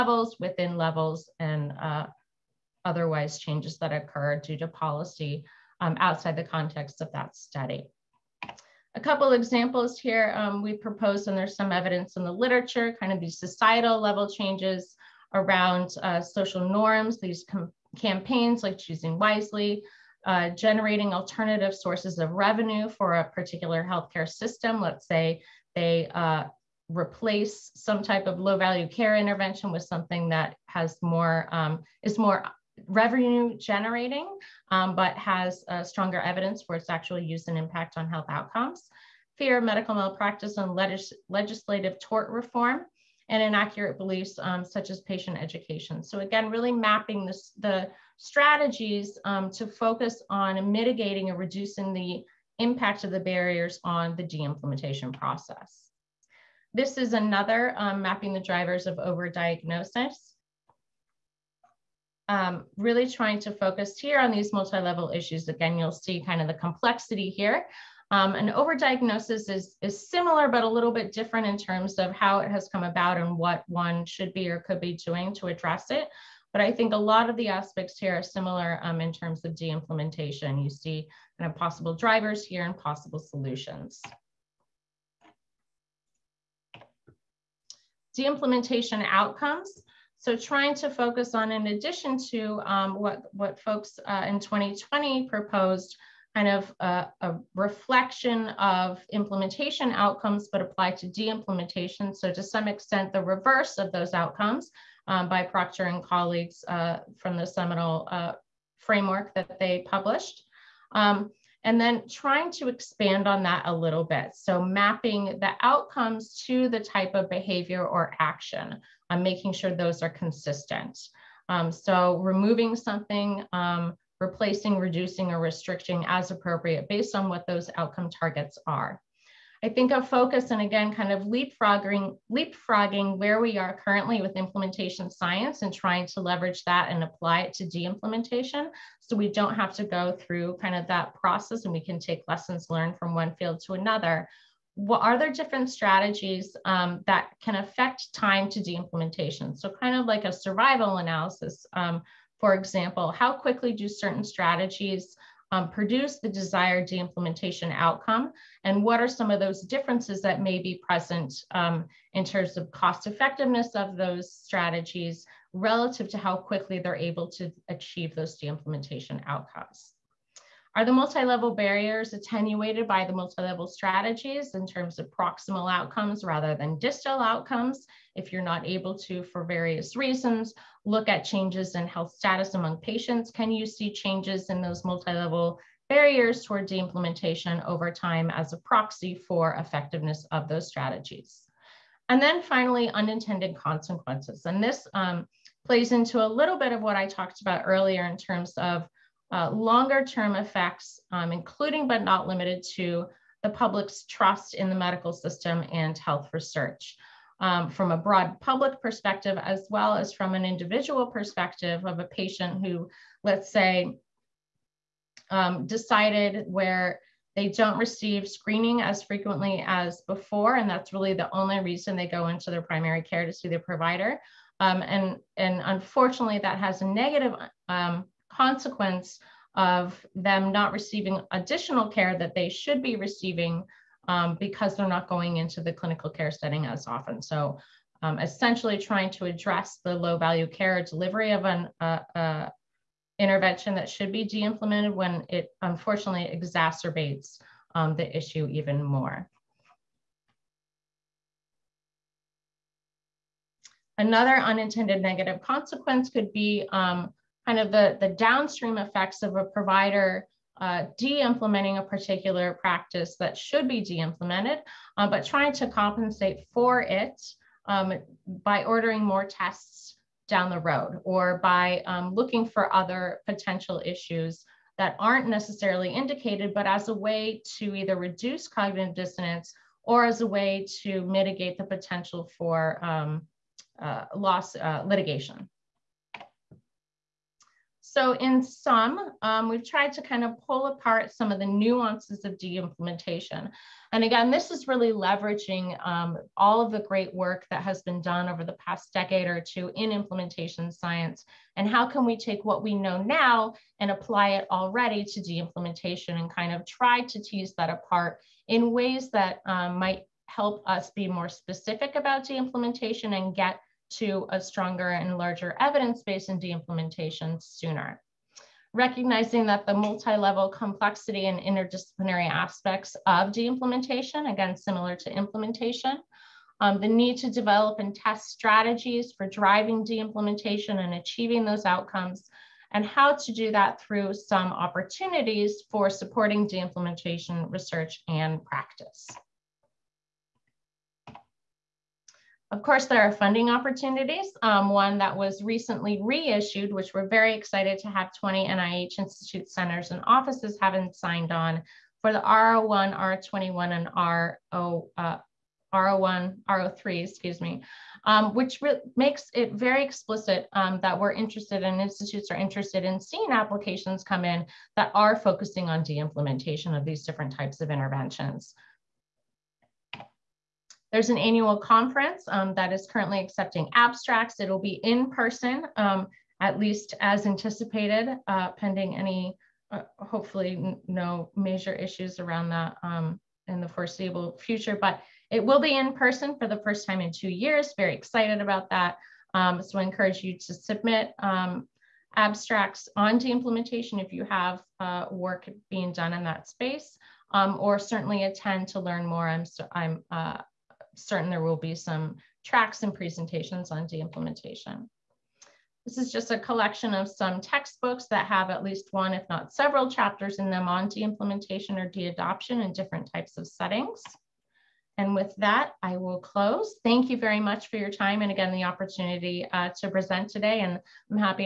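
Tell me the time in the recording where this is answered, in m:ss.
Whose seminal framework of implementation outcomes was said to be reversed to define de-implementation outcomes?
1:45.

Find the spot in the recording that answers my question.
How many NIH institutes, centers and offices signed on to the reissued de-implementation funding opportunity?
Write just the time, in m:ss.
5:48.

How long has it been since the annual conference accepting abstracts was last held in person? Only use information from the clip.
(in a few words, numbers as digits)
two years.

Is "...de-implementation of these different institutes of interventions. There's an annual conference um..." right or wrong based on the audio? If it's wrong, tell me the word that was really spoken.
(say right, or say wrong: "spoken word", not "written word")
wrong: "types", not "institutes".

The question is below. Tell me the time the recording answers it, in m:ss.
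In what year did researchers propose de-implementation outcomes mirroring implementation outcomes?
1:34.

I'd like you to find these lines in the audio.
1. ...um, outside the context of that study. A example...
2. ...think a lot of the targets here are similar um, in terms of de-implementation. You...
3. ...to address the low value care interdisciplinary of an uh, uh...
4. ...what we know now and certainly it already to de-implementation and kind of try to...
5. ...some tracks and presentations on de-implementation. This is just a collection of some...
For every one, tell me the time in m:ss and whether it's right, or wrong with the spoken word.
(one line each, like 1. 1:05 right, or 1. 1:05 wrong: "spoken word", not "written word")
1. 0:05 wrong: "couple", not "example"
2. 1:16 wrong: "aspects", not "targets"
3. 3:59 wrong: "delivery", not "interdisciplinary"
4. 5:02 wrong: "apply", not "certainly"
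5. 6:41 right.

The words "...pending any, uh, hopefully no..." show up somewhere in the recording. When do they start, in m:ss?
6:18.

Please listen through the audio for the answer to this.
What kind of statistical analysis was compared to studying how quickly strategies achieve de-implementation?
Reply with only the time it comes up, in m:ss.
2:30.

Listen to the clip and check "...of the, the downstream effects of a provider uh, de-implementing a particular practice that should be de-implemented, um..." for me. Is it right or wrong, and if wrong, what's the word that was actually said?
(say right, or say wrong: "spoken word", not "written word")
right.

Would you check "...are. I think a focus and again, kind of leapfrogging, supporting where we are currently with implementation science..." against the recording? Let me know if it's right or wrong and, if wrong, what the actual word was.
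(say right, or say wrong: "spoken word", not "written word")
wrong: "leapfrogging", not "supporting".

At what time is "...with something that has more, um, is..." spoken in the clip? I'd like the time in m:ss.
0:29.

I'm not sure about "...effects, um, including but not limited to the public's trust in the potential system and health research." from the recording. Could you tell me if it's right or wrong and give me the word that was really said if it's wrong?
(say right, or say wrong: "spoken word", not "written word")
wrong: "medical", not "potential".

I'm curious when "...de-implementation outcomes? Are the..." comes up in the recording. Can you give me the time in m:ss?
2:48.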